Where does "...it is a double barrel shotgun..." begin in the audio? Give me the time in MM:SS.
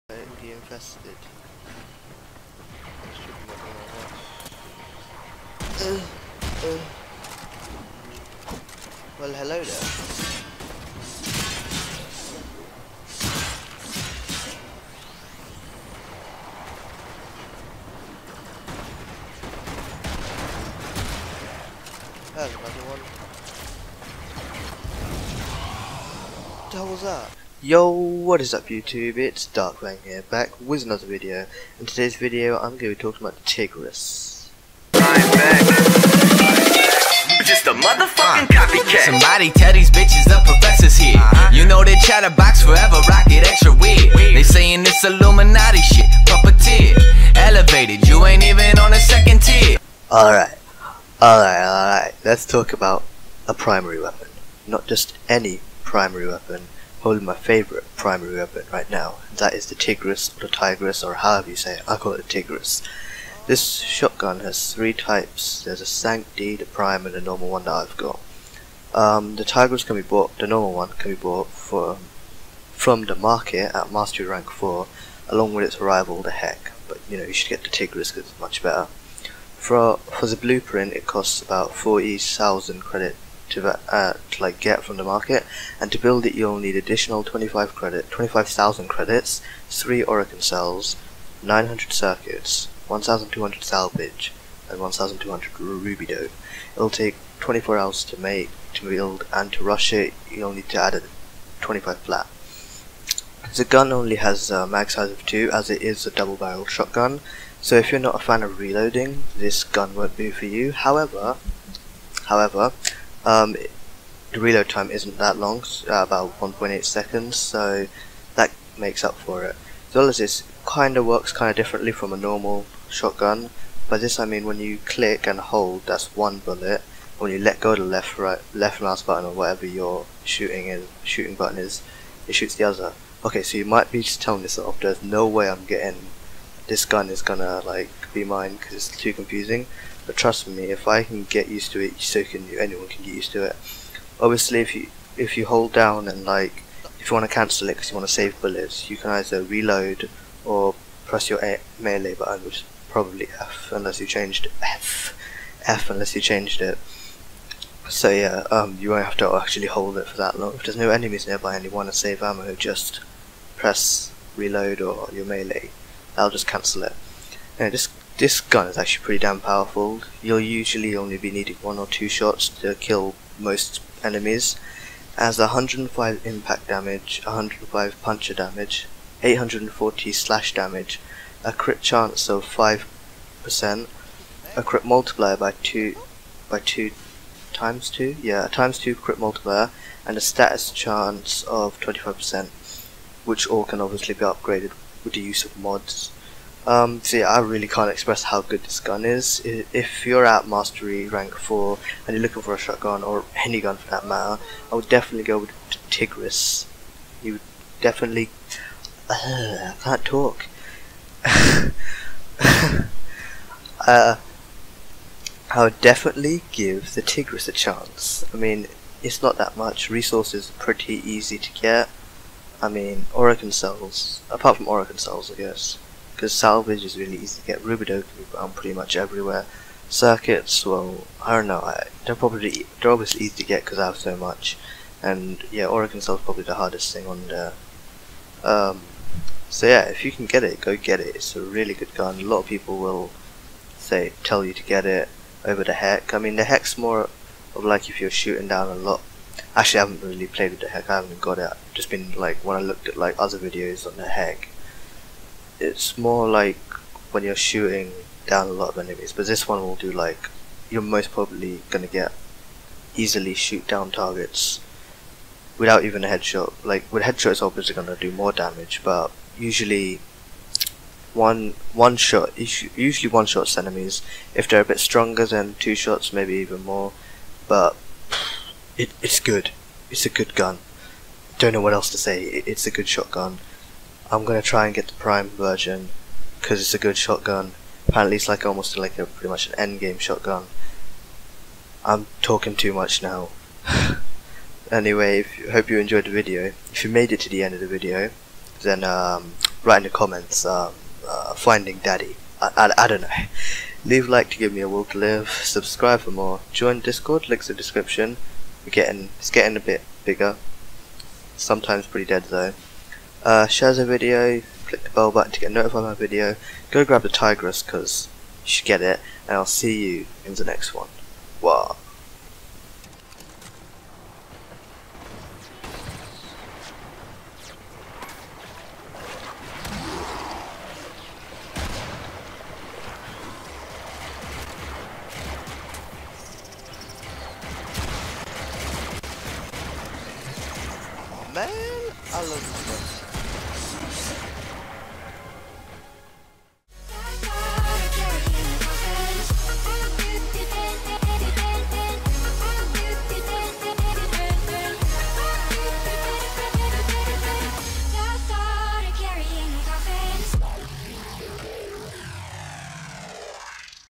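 01:45.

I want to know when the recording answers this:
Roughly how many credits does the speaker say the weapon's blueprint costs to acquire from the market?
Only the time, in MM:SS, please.
01:21.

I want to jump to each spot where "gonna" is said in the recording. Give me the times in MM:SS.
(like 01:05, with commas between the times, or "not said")
02:17, 04:21, 04:27, 04:44.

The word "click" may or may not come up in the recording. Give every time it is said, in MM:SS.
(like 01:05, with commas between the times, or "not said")
02:04, 05:14.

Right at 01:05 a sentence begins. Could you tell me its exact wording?
There's a Sancti, the Prime, and the normal one that I've got.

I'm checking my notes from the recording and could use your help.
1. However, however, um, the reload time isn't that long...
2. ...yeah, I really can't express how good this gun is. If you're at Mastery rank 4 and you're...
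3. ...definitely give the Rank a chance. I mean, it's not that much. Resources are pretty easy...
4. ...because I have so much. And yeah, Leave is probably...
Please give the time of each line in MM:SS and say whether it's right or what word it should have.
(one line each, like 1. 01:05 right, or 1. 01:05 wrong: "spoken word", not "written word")
1. 01:50 right
2. 03:17 right
3. 03:35 wrong: "Tigris", not "Rank"
4. 03:53 wrong: "Orokin", not "Leave".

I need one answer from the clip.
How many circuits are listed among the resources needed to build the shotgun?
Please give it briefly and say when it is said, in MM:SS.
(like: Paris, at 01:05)
900, at 01:31.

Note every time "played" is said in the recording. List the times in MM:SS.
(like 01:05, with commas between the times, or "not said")
04:10.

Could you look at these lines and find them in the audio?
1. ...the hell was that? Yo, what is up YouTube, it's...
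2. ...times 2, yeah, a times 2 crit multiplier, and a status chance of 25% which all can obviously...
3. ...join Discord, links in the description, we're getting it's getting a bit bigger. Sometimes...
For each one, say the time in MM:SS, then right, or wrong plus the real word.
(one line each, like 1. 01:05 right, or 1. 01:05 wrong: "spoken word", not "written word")
1. 00:26 right
2. 03:07 right
3. 05:06 right.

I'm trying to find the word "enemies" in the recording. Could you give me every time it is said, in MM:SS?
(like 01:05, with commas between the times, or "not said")
02:40, 02:54, 04:18, 04:33.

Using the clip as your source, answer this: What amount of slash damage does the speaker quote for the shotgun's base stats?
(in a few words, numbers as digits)
840.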